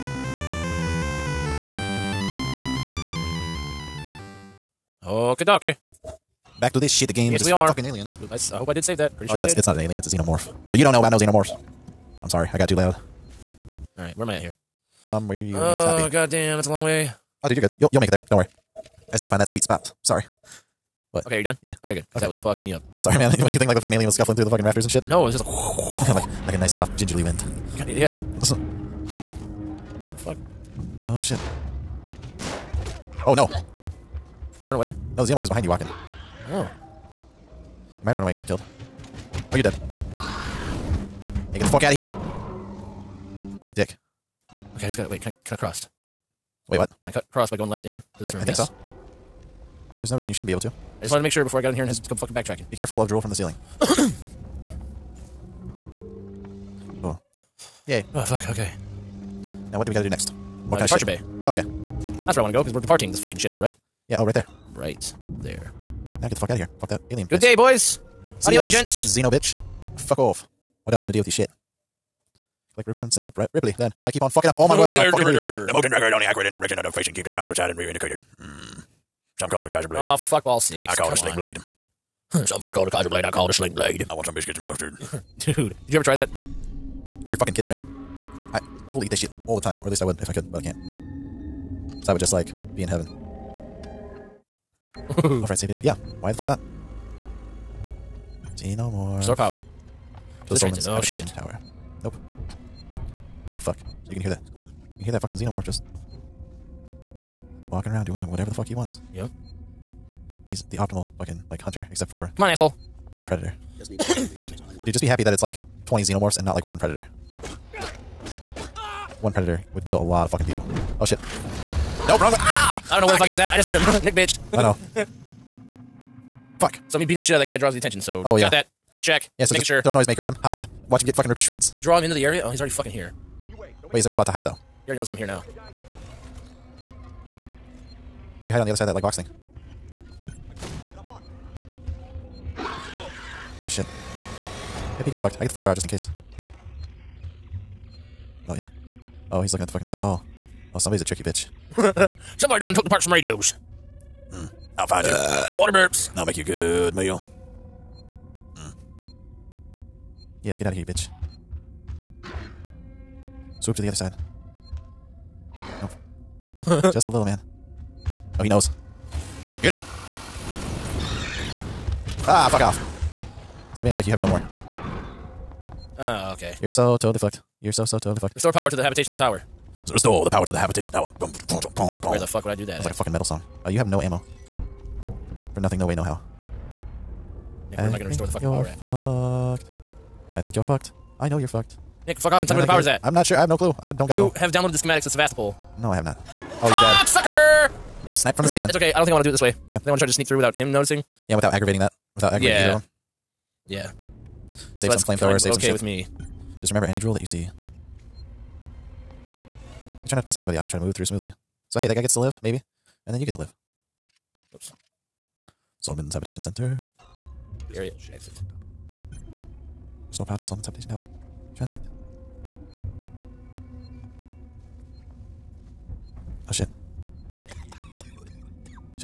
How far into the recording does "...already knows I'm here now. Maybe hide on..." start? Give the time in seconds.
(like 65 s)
134 s.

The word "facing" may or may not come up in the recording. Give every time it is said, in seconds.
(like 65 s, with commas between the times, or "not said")
76 s.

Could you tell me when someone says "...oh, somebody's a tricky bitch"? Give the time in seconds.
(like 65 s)
150 s.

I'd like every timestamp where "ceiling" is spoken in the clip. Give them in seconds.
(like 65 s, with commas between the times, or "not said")
53 s, 198 s.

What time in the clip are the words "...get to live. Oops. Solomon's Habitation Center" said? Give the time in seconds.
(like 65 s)
213 s.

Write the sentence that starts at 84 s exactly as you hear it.
I want some biscuits and mustard.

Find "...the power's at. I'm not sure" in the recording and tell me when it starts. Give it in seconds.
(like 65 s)
192 s.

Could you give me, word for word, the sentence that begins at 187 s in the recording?
Yeah, where I am I going to restore the fucking power at?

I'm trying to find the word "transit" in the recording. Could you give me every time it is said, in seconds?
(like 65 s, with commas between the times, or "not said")
100 s, 221 s.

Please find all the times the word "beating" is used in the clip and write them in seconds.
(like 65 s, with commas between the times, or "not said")
127 s.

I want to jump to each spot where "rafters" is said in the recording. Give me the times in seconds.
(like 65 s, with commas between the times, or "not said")
24 s.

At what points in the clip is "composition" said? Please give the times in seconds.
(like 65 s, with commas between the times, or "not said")
not said.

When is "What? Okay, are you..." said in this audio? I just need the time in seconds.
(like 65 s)
21 s.